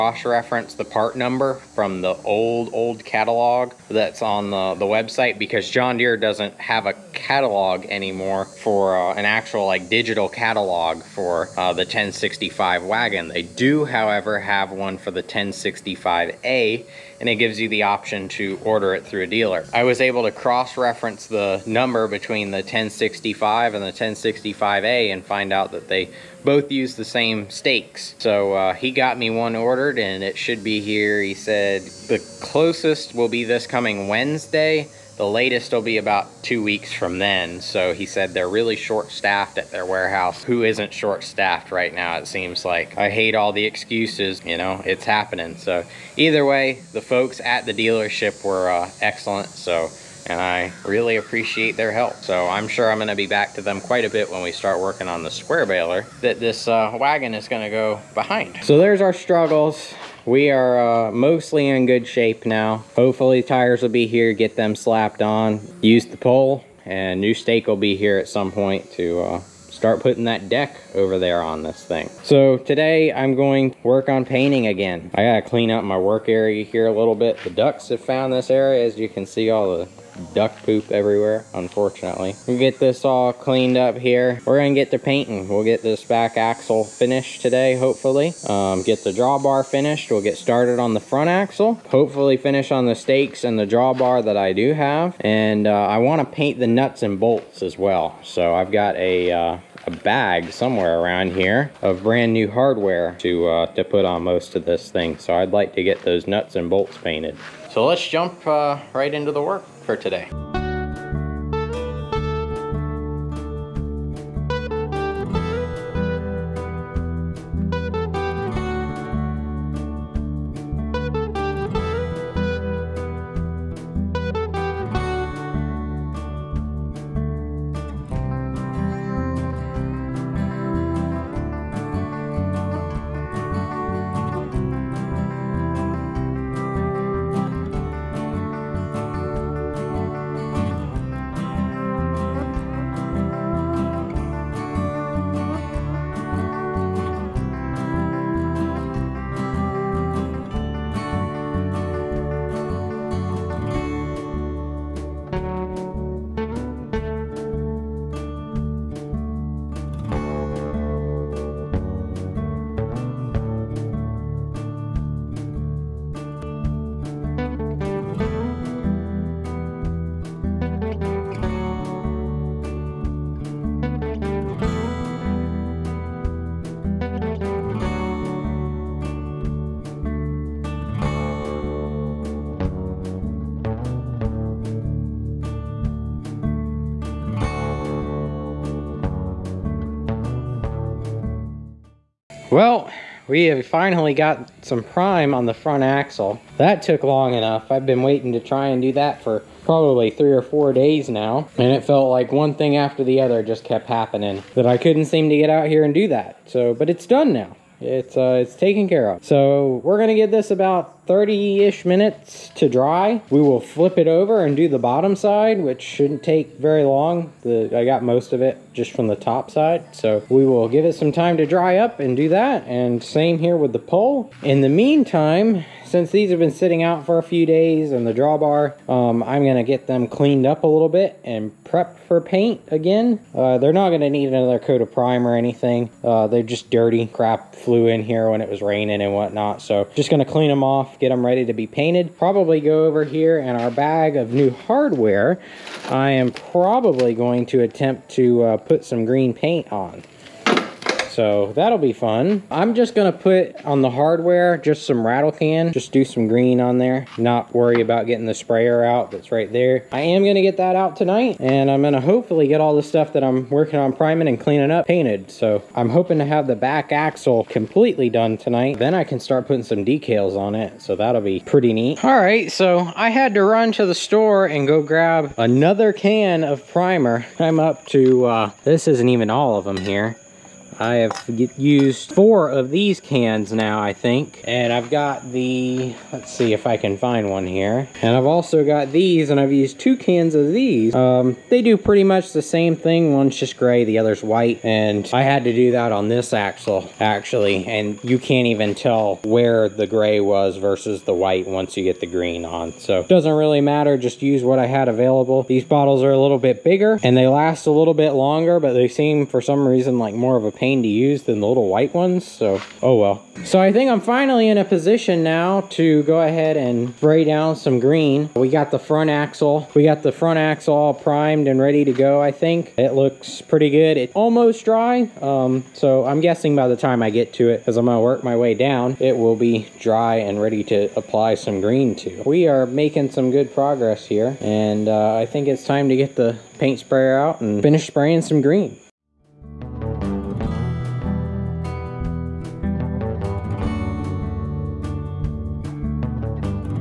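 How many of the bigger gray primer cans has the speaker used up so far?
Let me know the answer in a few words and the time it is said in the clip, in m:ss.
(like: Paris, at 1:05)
2, at 4:49.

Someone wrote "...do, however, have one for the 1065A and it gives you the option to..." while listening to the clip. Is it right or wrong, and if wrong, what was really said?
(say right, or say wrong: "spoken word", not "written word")
right.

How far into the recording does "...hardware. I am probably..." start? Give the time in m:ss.
4:04.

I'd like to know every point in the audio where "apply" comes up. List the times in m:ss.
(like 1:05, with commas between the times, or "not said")
5:30.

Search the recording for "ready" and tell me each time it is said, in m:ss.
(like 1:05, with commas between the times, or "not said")
4:01, 5:21, 5:30.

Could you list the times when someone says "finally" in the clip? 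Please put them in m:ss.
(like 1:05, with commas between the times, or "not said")
3:13, 5:14.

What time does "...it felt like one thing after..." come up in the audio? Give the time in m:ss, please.
3:21.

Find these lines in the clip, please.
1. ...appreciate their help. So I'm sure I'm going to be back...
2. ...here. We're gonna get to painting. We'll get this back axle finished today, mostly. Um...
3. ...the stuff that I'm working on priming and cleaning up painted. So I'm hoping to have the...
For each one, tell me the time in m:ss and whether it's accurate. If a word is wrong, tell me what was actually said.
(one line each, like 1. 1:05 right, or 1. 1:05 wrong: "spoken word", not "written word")
1. 0:51 right
2. 1:23 wrong: "hopefully", not "mostly"
3. 4:22 right.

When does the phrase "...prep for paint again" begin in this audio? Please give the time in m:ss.
3:51.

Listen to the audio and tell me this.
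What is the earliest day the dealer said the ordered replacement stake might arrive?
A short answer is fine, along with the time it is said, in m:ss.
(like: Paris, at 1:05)
Wednesday, at 0:34.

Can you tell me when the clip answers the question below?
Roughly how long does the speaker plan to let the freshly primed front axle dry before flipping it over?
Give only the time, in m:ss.
3:31.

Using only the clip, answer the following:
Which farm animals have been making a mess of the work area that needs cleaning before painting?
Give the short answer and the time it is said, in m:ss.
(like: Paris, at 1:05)
ducks, at 1:17.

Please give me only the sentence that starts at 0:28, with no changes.
So uh, he got me one ordered and it should be here.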